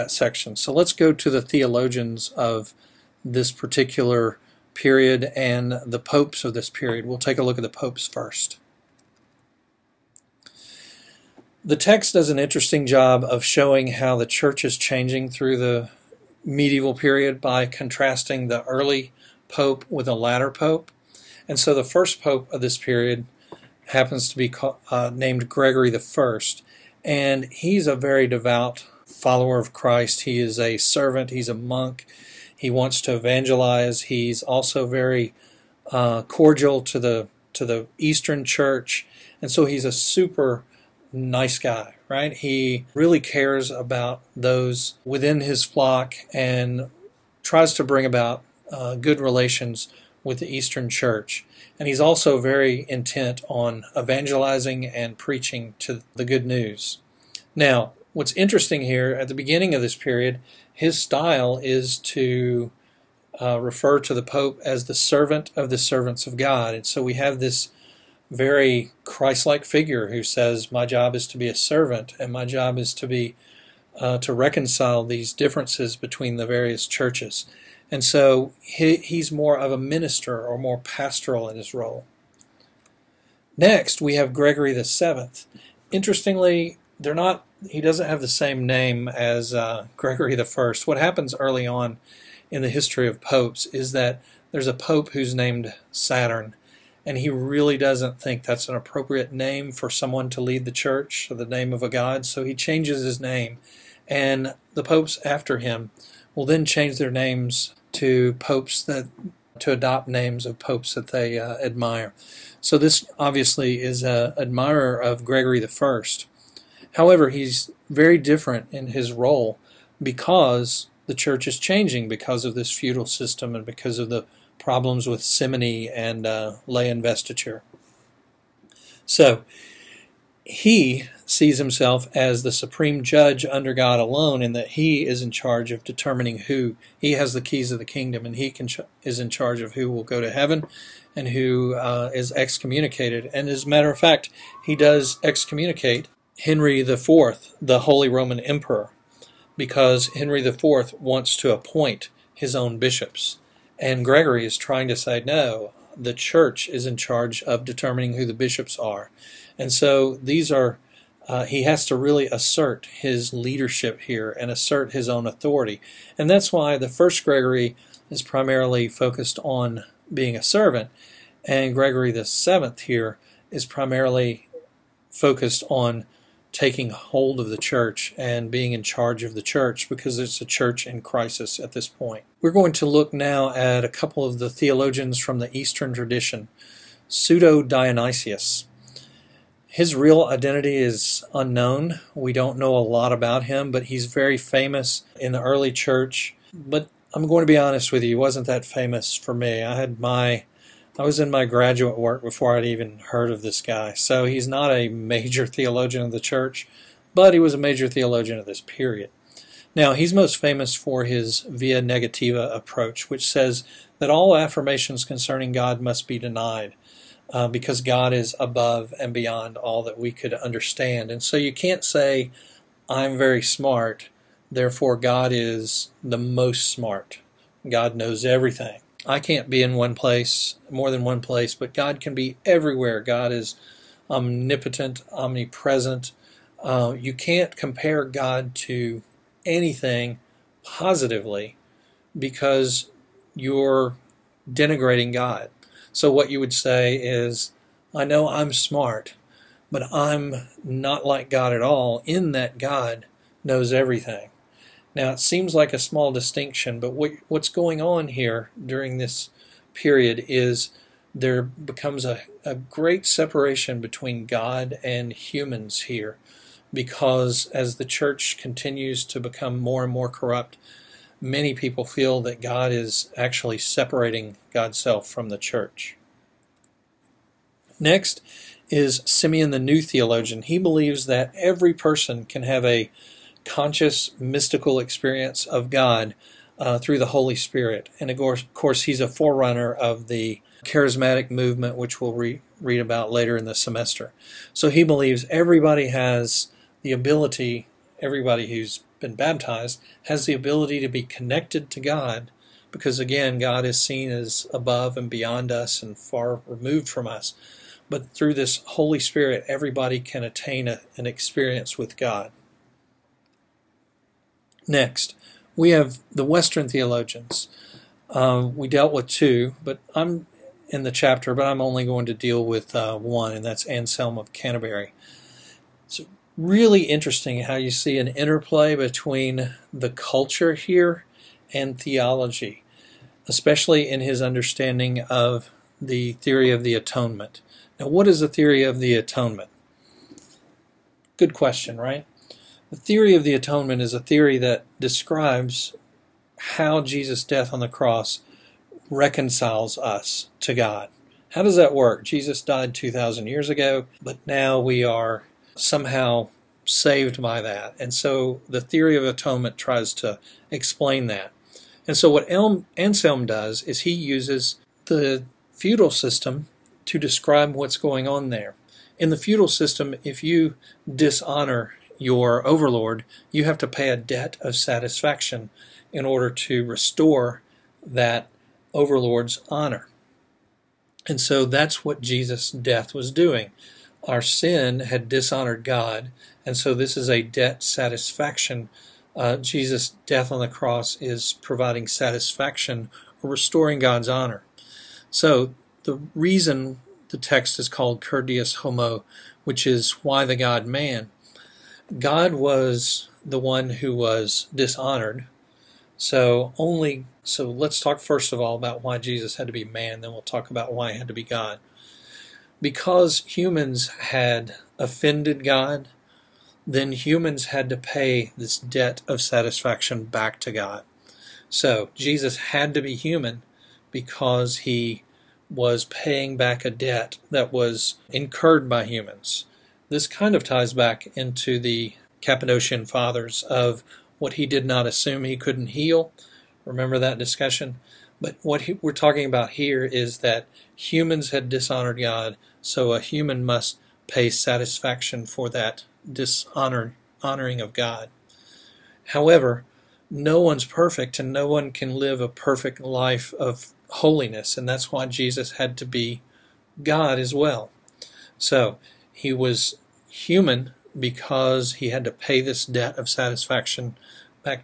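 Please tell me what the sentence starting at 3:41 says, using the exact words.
And so you can't say, I'm very smart, therefore God is the most smart.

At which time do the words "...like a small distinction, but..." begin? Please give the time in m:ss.
4:15.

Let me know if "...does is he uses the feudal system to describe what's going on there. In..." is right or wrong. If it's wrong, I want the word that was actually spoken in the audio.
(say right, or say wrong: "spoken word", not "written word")
right.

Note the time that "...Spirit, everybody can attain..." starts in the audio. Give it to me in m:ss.
5:08.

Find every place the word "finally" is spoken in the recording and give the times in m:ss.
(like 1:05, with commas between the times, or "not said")
not said.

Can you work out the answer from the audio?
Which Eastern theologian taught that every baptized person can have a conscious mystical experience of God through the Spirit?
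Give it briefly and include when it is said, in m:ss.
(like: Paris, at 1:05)
Simeon the New Theologian, at 4:39.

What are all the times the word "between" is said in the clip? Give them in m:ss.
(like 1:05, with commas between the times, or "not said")
1:15, 4:23, 5:28.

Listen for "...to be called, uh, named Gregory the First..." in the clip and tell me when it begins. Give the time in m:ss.
0:24.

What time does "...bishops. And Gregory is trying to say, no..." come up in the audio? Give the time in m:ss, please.
2:32.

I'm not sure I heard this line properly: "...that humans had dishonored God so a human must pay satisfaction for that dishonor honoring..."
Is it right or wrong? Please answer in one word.
right.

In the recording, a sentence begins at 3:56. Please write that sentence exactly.
Uh, you can't compare God to anything positively because you're denigrating God.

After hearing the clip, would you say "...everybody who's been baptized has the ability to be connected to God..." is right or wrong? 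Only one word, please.
right.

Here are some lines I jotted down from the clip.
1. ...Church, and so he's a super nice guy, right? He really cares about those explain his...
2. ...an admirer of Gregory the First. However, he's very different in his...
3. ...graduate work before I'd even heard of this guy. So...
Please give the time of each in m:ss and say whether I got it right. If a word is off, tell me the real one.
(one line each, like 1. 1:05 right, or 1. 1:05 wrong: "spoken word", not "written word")
1. 0:38 wrong: "within", not "explain"
2. 1:54 right
3. 3:21 right.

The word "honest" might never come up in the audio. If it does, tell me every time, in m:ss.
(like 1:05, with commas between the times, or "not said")
3:17.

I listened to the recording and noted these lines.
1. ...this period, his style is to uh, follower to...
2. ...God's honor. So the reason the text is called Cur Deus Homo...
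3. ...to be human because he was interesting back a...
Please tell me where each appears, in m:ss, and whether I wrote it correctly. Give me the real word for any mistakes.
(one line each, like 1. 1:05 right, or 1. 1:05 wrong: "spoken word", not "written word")
1. 0:59 wrong: "refer", not "follower"
2. 6:33 right
3. 7:02 wrong: "paying", not "interesting".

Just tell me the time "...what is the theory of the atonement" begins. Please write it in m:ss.
5:37.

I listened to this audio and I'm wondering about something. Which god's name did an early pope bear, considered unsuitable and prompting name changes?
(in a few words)
Saturn.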